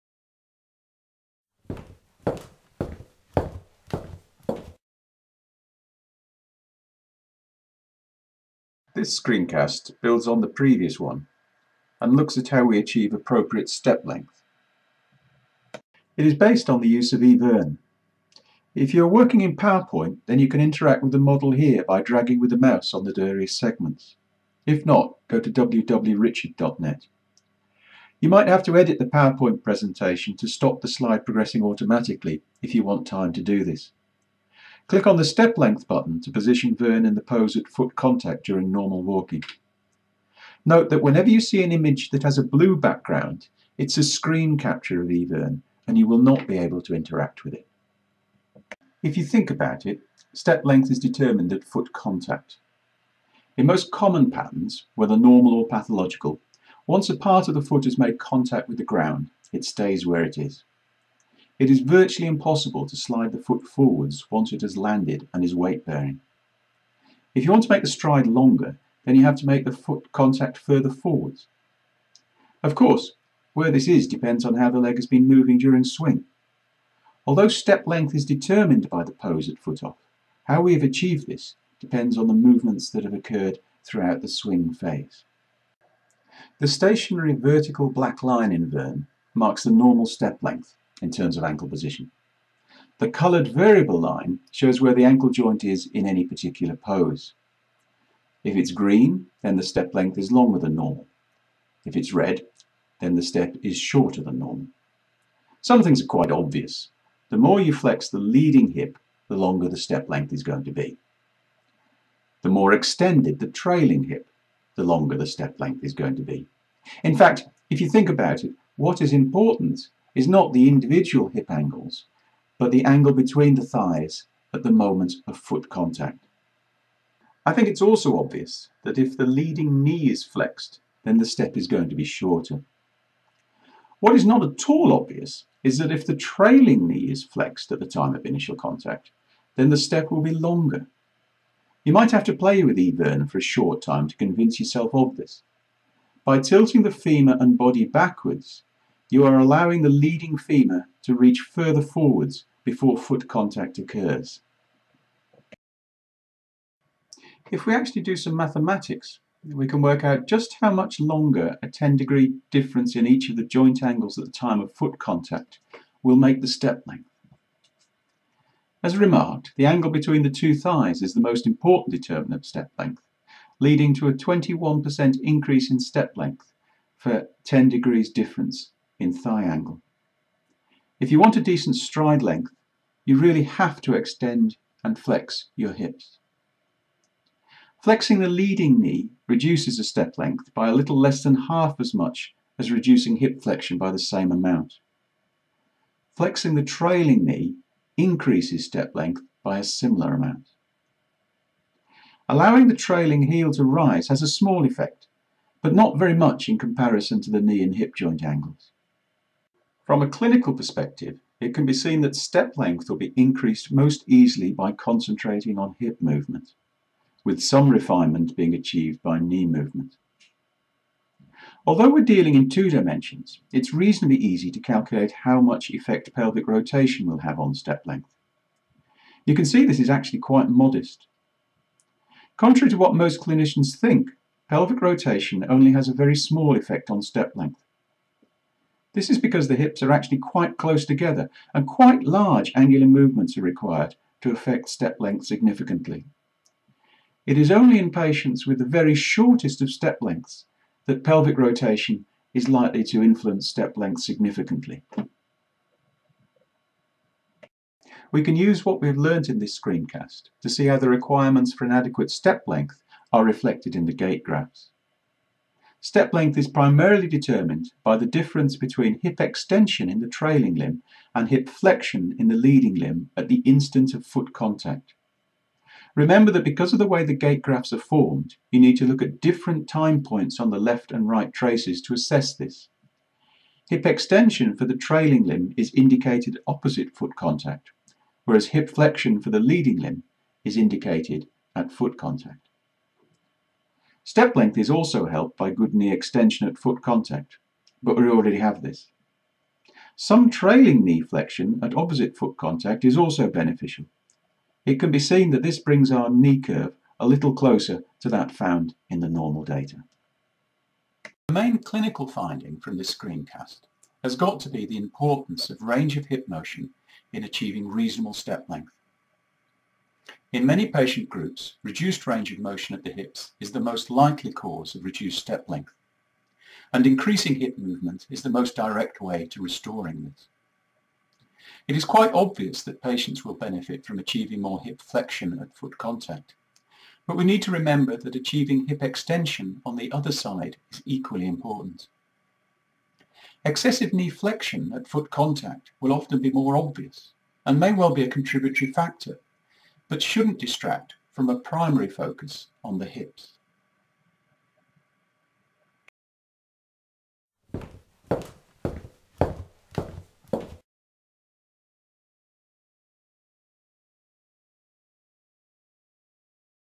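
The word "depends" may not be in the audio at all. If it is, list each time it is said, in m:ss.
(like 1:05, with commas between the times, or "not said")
1:14, 1:21.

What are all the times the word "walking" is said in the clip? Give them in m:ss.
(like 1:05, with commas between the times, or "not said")
0:39.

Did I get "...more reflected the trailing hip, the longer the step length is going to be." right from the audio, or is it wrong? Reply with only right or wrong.
wrong.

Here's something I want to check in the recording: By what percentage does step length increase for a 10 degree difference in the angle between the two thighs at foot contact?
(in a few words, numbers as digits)
21%.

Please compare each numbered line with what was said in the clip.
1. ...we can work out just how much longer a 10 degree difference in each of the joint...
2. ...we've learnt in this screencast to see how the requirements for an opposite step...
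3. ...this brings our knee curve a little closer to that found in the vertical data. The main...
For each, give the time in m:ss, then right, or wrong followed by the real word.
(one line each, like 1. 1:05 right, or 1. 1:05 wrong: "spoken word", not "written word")
1. 2:39 right
2. 4:18 wrong: "adequate", not "opposite"
3. 5:05 wrong: "normal", not "vertical".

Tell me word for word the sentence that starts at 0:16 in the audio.
It is based on the use of eVern.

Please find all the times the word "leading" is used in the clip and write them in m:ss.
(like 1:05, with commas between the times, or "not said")
1:48, 2:09, 2:29, 2:53, 3:08, 4:32, 4:49.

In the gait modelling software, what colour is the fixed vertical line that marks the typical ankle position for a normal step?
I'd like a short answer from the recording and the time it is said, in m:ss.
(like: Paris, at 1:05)
Black, at 1:27.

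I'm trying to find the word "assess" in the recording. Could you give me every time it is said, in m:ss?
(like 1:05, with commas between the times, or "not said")
4:41.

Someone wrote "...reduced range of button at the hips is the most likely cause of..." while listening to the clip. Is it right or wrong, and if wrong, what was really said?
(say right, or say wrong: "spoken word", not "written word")
wrong: "motion", not "button".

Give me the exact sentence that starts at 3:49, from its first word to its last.
You can see this is actually quite modest.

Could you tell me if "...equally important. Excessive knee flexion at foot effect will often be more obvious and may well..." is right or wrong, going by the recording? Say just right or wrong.
wrong.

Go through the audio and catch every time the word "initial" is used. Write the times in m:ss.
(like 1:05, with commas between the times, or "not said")
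2:18.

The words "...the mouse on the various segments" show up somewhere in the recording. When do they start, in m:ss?
0:22.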